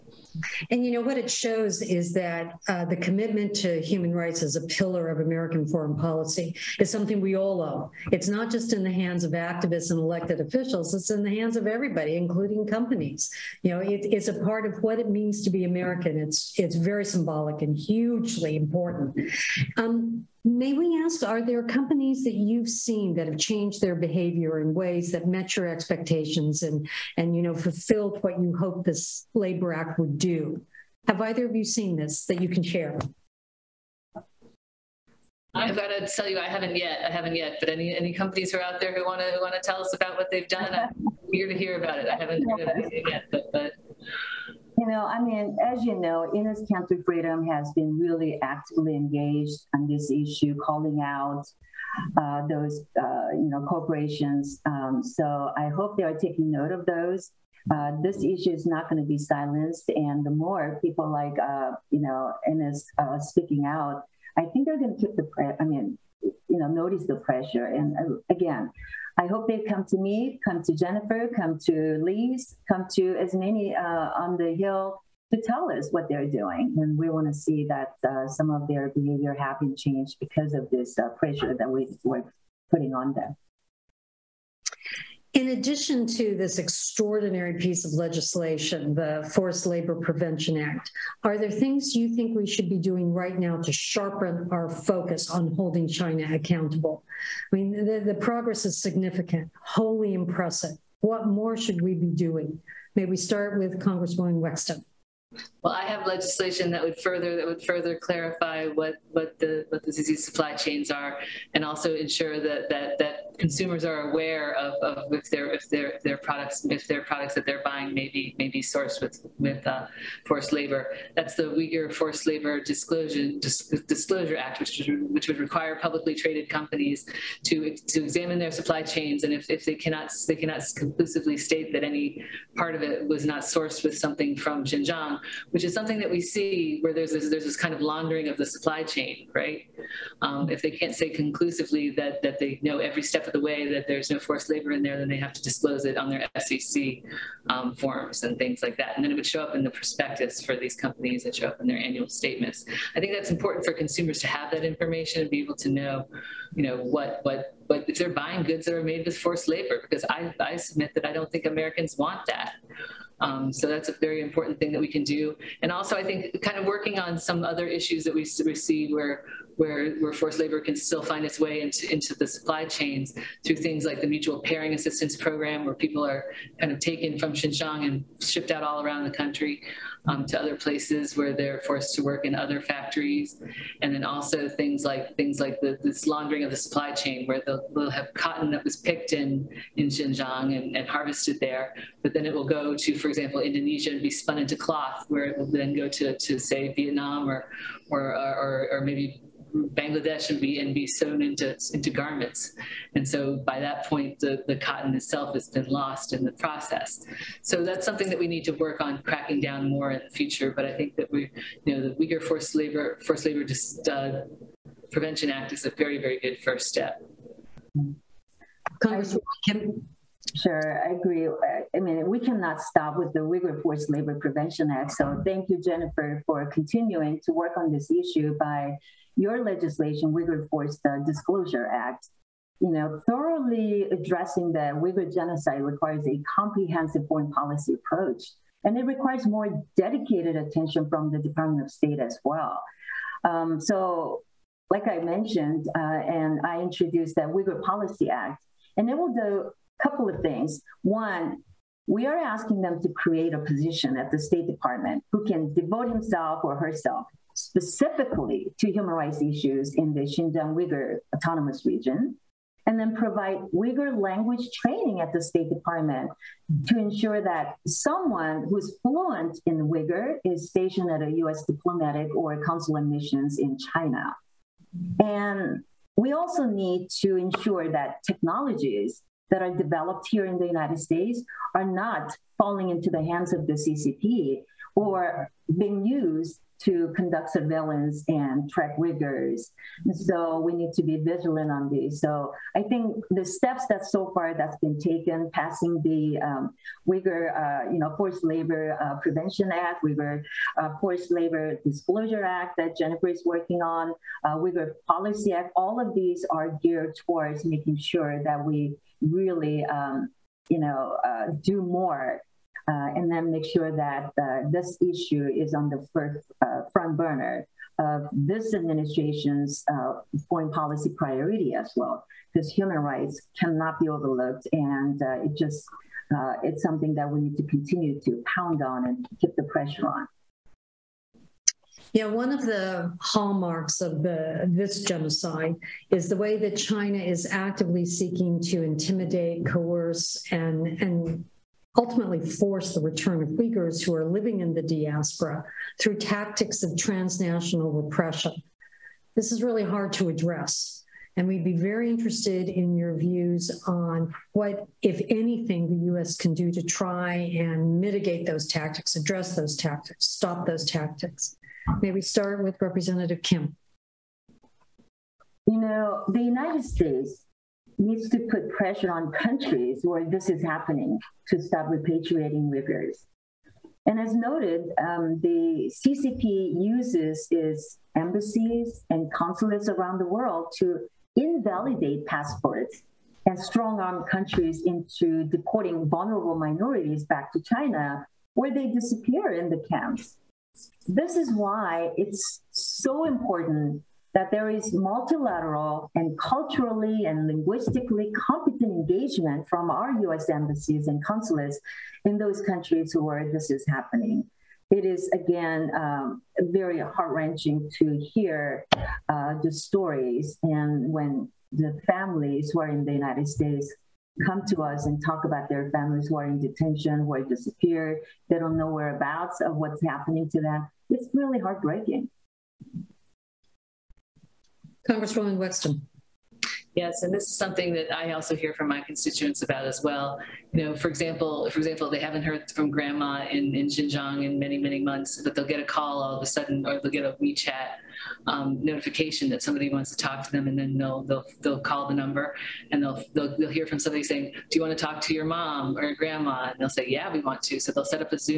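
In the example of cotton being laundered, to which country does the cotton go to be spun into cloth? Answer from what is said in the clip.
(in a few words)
Indonesia.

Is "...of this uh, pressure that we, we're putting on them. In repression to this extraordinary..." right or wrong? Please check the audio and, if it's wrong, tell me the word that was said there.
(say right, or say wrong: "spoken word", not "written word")
wrong: "addition", not "repression".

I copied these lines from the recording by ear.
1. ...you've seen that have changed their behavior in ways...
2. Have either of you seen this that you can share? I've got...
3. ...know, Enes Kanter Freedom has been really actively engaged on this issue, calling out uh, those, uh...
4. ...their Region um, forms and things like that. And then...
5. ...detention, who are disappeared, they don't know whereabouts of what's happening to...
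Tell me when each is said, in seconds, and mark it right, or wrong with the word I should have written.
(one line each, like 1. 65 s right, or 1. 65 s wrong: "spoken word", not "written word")
1. 22 s right
2. 31 s right
3. 45 s right
4. 146 s wrong: "SEC", not "Region"
5. 416 s right.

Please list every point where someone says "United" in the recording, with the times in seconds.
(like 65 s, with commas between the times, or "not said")
280 s, 366 s, 412 s.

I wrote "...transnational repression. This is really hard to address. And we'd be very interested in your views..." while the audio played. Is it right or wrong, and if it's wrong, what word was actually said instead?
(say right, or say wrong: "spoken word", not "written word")
right.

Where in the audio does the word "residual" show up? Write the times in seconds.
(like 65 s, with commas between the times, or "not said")
not said.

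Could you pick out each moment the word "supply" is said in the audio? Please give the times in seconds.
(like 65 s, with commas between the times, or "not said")
110 s, 128 s, 138 s, 172 s, 186 s.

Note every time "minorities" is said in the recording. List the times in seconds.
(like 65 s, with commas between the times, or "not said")
386 s.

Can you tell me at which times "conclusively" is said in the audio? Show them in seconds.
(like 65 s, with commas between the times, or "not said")
130 s, 141 s.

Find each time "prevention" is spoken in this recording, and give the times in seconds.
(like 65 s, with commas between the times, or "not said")
90 s, 214 s, 224 s, 299 s.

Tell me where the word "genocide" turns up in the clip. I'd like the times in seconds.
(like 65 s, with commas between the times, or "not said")
235 s, 334 s.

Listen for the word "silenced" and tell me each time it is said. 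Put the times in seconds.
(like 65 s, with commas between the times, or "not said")
59 s.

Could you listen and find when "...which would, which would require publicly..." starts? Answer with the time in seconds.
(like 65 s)
124 s.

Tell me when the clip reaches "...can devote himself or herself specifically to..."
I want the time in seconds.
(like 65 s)
255 s.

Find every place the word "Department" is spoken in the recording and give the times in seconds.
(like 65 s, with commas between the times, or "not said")
241 s, 254 s, 265 s.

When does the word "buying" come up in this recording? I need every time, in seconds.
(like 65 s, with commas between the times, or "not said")
117 s, 158 s.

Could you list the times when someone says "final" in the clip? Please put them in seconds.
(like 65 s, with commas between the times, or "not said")
not said.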